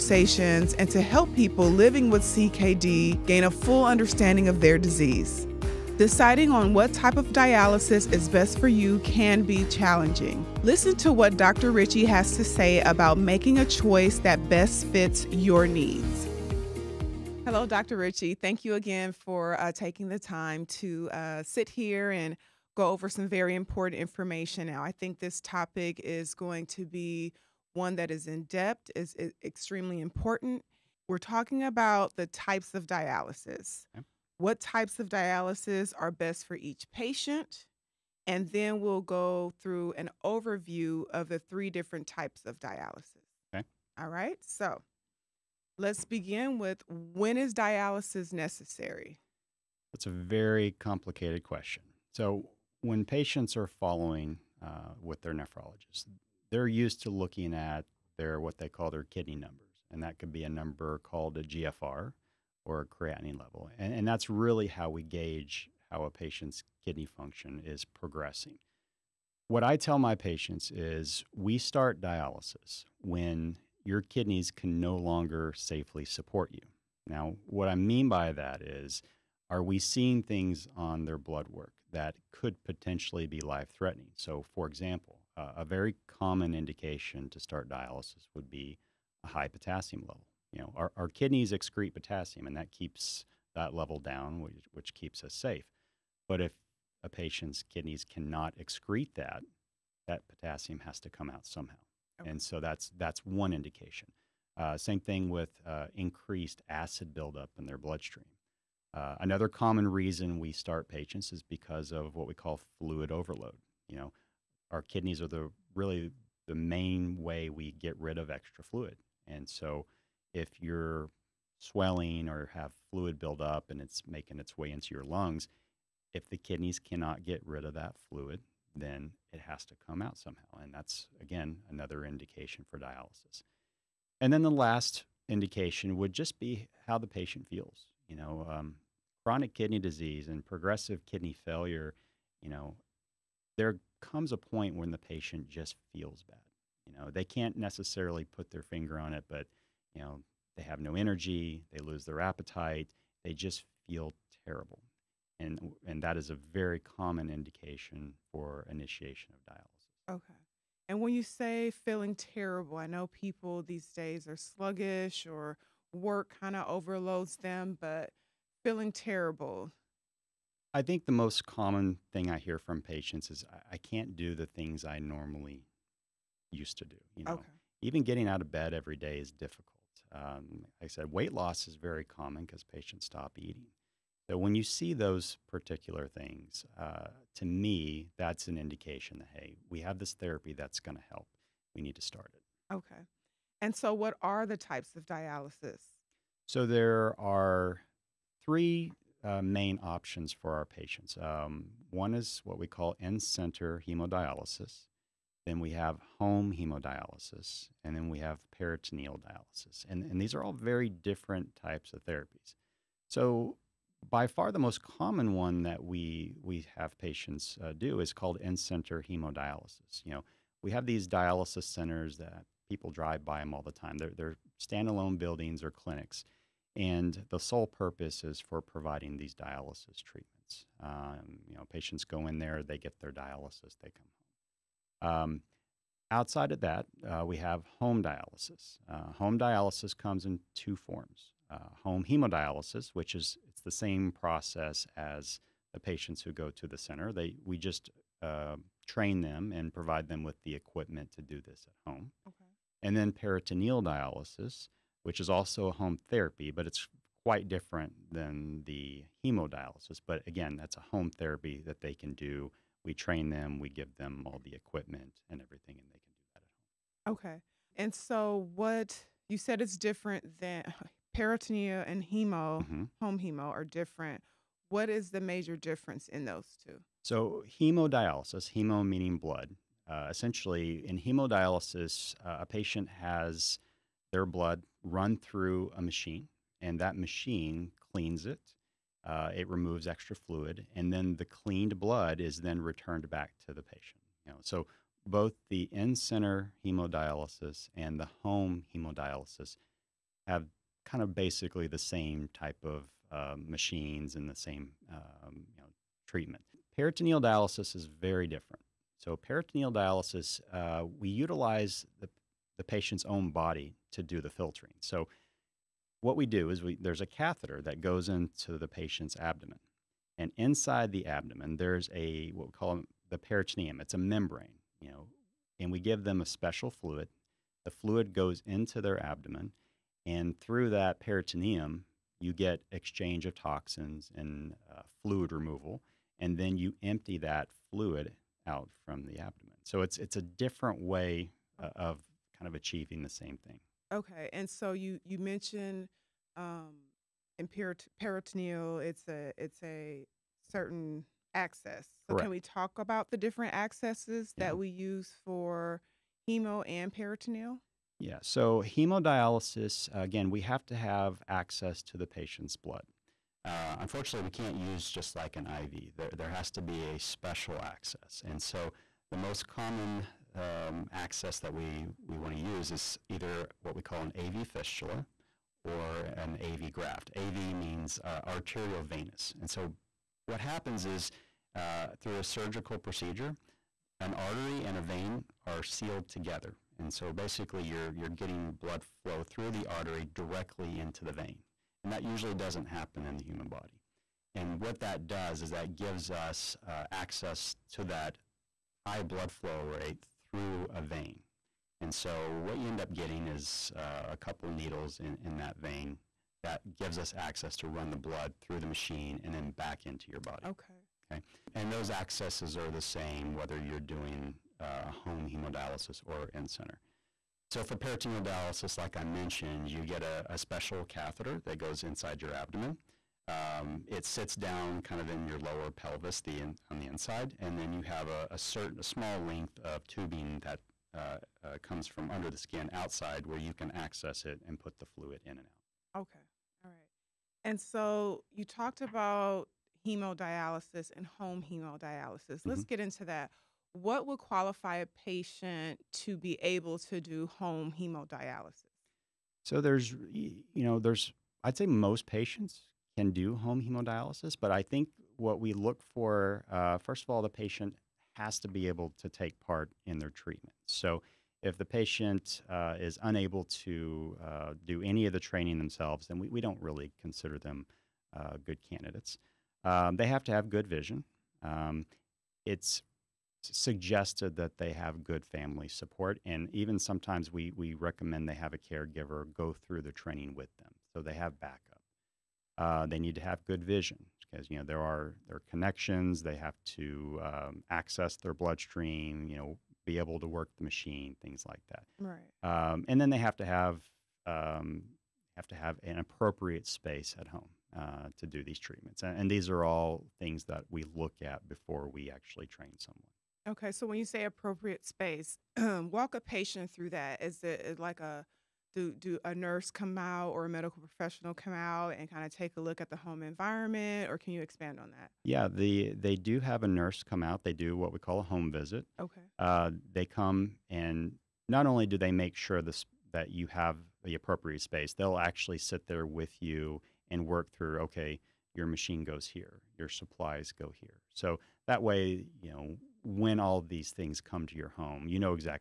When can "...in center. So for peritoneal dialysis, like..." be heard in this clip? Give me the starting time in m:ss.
6:56.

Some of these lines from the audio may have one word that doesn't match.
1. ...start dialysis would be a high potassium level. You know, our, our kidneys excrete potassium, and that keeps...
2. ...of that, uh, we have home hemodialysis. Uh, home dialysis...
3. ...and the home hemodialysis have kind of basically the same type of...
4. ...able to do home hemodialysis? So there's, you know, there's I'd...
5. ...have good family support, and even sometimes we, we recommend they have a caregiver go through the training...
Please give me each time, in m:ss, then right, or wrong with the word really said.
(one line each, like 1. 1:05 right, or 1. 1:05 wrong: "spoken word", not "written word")
1. 1:27 right
2. 3:56 wrong: "dialysis", not "hemodialysis"
3. 4:57 right
4. 7:26 right
5. 7:54 right.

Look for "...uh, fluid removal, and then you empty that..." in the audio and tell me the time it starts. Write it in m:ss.
5:34.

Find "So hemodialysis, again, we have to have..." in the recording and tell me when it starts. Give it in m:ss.
5:58.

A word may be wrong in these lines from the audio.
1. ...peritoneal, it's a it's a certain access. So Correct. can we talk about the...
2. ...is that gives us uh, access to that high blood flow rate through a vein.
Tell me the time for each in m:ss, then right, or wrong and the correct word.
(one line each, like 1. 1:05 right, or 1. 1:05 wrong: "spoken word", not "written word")
1. 5:48 right
2. 6:35 right.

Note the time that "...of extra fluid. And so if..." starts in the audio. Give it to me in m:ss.
1:58.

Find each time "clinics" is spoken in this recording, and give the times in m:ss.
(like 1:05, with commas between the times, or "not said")
3:45.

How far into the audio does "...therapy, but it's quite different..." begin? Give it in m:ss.
4:16.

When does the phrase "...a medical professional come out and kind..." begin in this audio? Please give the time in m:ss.
8:30.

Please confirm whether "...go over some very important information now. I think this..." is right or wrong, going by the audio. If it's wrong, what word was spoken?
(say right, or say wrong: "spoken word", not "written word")
right.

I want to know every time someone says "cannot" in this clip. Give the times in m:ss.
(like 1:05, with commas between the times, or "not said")
1:38, 2:06.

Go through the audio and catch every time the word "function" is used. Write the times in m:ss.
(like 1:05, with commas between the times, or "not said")
1:07.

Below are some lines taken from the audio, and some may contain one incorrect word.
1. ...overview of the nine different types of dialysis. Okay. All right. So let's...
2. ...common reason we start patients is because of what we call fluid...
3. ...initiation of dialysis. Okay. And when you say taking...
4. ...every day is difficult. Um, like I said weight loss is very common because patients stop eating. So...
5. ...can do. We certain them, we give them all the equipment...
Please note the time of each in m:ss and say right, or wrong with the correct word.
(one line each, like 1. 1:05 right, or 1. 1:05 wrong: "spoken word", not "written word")
1. 0:40 wrong: "three", not "nine"
2. 1:49 right
3. 2:38 wrong: "feeling", not "taking"
4. 2:58 right
5. 4:21 wrong: "train", not "certain".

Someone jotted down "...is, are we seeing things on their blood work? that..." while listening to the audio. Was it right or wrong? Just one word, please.
right.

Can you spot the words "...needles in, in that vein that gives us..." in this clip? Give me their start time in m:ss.
6:44.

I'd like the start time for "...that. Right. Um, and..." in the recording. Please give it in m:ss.
8:11.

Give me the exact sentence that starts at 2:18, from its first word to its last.
You know, um, chronic kidney disease and progressive kidney failure, you know, there comes a point when the patient just feels bad.